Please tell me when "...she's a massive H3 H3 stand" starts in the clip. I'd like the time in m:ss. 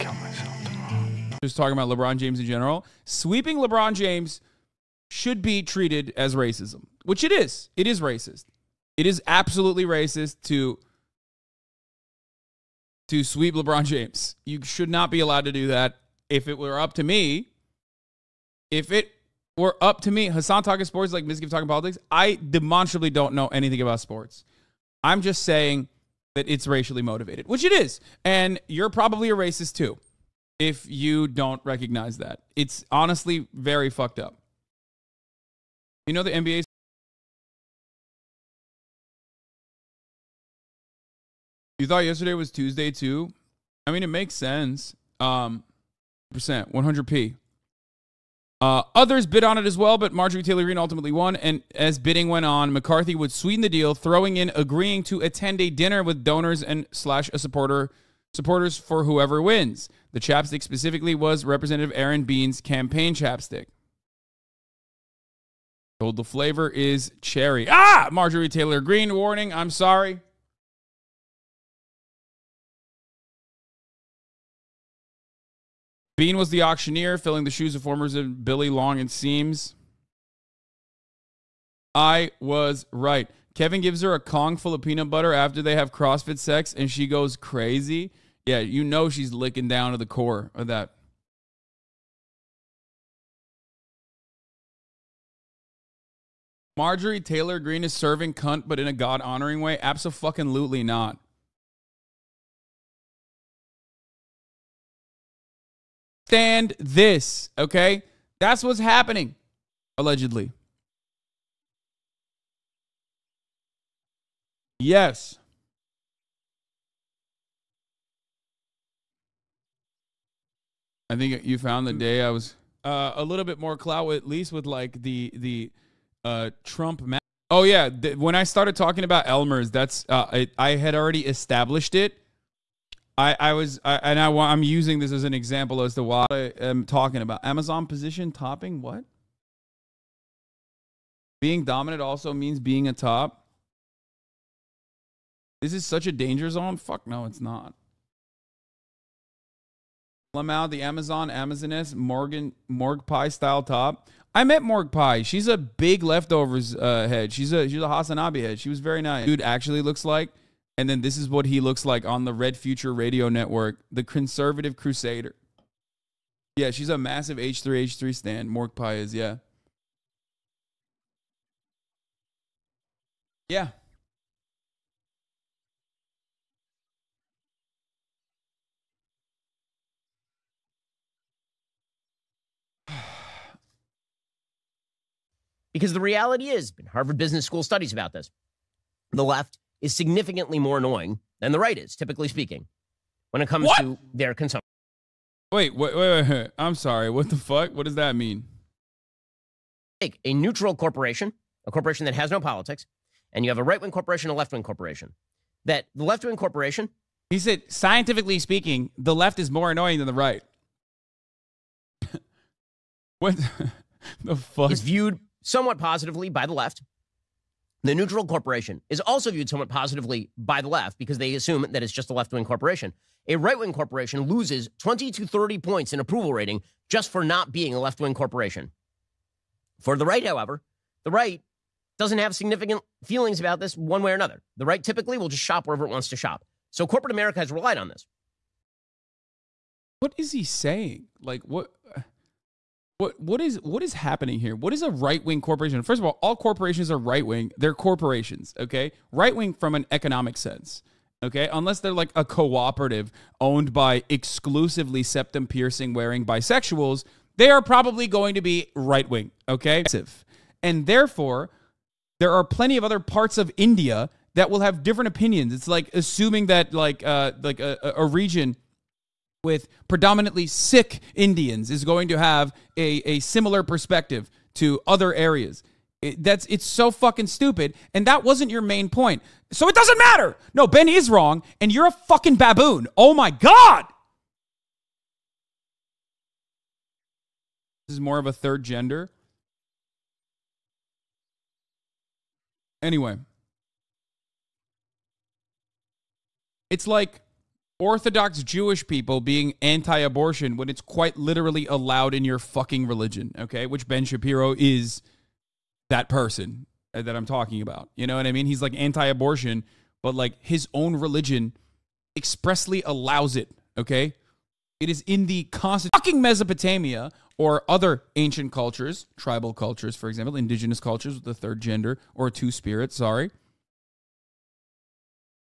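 2:46.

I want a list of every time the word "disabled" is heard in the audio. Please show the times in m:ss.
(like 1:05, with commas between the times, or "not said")
not said.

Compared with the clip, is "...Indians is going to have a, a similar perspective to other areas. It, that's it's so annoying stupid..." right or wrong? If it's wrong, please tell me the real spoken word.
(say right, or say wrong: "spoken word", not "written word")
wrong: "fucking", not "annoying".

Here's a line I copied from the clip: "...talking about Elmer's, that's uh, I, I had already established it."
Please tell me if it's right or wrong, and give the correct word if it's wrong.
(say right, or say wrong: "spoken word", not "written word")
right.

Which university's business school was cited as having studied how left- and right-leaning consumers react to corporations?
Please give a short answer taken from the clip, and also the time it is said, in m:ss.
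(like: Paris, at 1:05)
Harvard, at 3:06.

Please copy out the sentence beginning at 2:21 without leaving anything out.
Being dominant also means being a top.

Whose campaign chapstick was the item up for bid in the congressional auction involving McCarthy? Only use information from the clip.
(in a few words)
Aaron Bean.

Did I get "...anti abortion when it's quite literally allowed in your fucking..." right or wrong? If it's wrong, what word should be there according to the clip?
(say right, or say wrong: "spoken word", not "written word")
right.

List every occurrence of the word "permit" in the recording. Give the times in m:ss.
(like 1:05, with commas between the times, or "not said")
not said.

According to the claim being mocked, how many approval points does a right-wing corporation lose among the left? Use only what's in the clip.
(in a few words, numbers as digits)
20 to 30.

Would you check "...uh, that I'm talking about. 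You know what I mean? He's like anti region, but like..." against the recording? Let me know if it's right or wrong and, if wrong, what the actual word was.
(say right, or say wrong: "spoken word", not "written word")
wrong: "abortion", not "region".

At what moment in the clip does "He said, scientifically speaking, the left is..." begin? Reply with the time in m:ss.
3:27.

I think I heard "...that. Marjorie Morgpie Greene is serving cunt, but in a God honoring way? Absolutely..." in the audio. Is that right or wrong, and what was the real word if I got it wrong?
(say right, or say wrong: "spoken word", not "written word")
wrong: "Taylor", not "Morgpie".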